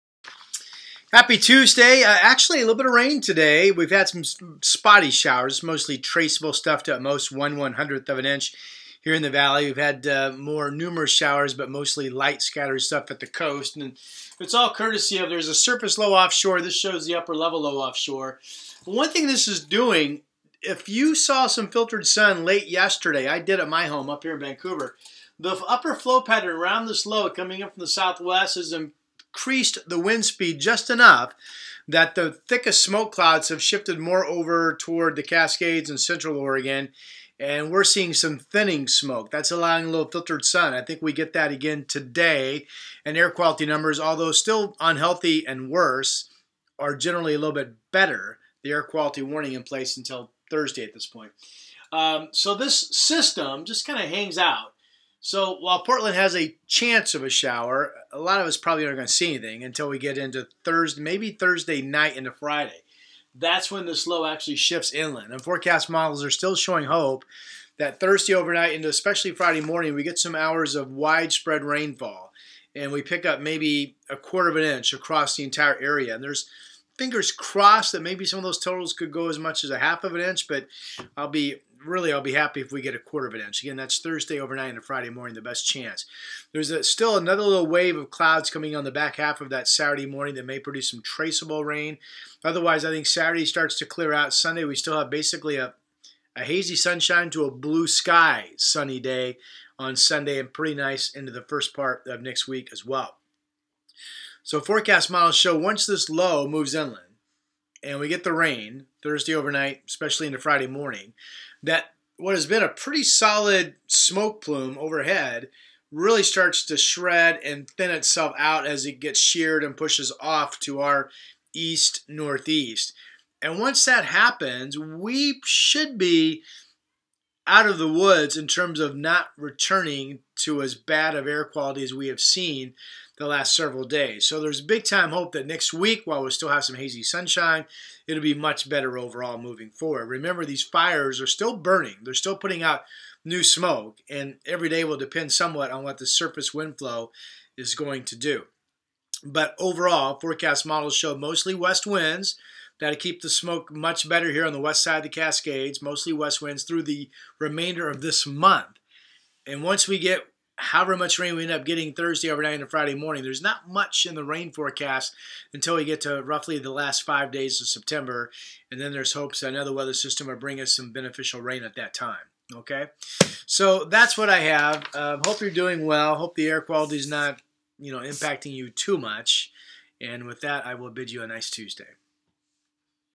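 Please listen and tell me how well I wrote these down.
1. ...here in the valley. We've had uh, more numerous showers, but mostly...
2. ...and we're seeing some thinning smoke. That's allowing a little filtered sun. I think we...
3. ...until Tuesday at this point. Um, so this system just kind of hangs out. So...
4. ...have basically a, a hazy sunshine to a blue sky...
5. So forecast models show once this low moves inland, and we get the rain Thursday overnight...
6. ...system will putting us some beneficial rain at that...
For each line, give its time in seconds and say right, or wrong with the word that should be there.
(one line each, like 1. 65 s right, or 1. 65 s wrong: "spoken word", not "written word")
1. 9 s right
2. 37 s right
3. 49 s wrong: "Thursday", not "Tuesday"
4. 94 s right
5. 104 s right
6. 169 s wrong: "bring", not "putting".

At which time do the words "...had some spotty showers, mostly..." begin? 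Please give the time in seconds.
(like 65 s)
3 s.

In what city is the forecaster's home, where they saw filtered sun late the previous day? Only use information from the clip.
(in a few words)
Vancouver.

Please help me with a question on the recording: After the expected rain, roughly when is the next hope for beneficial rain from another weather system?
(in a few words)
last five days of September.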